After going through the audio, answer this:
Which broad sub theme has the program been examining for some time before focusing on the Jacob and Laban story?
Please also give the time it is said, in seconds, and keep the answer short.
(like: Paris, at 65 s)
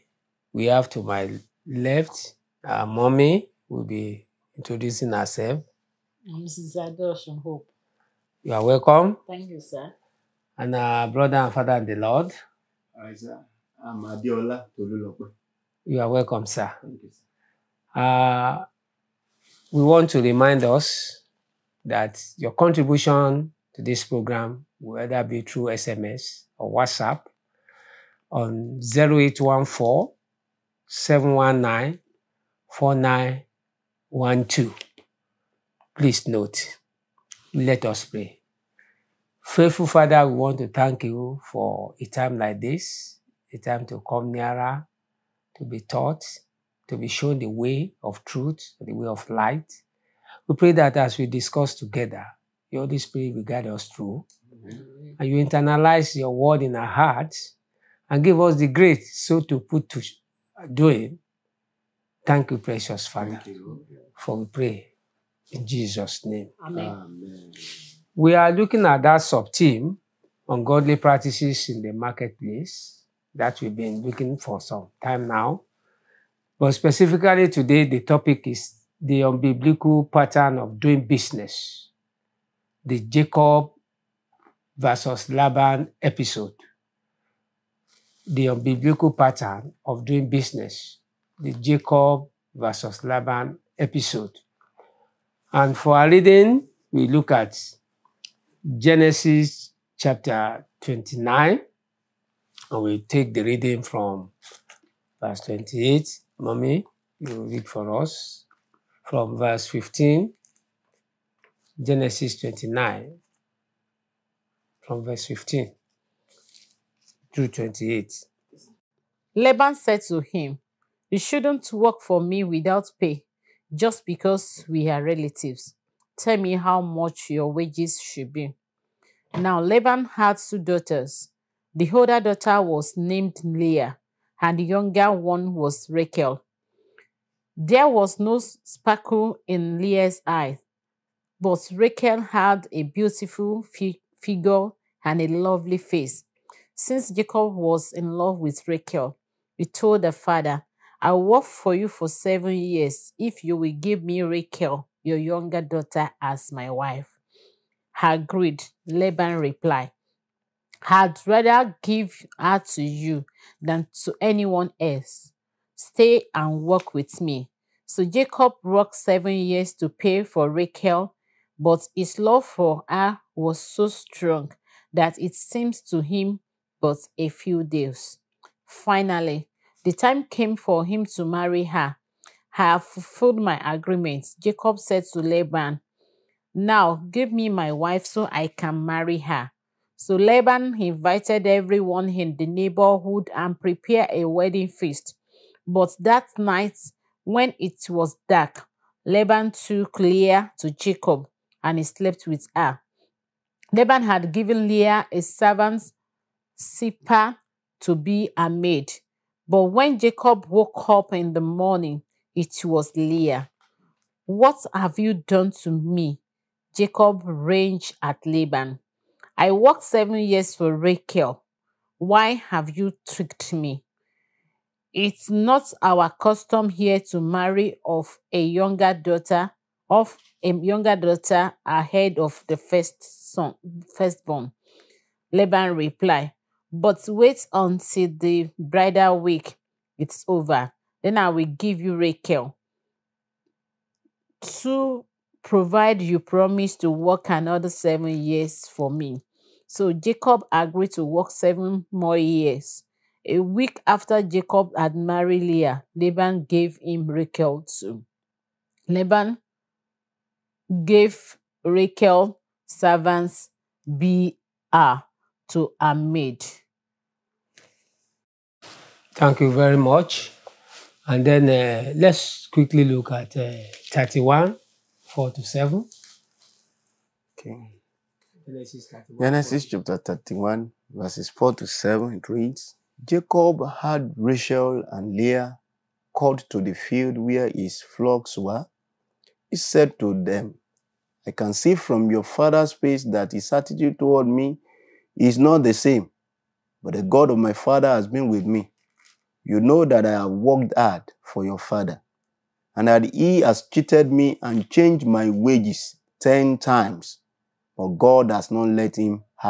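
Ungodly practices in the marketplace, at 70 s.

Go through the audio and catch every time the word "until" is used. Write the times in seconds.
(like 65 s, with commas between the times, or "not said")
237 s.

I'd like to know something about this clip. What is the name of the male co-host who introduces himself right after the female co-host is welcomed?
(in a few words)
Tolulope.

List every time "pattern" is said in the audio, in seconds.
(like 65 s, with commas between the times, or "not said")
80 s, 89 s.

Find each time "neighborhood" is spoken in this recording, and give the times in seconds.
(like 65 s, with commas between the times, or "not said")
192 s.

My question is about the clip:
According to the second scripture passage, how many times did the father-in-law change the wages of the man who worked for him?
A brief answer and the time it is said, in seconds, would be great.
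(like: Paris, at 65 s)
10, at 306 s.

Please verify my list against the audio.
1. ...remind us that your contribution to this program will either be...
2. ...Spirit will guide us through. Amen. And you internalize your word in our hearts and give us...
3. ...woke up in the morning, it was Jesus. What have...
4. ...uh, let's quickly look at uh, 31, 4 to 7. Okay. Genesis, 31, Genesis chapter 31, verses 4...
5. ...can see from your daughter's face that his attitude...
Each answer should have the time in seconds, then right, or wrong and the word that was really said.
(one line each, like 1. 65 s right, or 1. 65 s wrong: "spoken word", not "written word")
1. 20 s right
2. 52 s right
3. 210 s wrong: "Leah", not "Jesus"
4. 271 s right
5. 291 s wrong: "father", not "daughter".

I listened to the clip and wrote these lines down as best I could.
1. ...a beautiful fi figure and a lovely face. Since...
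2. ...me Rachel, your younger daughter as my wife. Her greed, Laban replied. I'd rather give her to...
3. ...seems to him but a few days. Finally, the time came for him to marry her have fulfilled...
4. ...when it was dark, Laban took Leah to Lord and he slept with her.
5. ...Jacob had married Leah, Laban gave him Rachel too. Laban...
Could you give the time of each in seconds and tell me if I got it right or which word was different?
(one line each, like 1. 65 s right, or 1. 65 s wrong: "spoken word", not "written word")
1. 142 s right
2. 154 s right
3. 175 s right
4. 197 s wrong: "Jacob", not "Lord"
5. 254 s right.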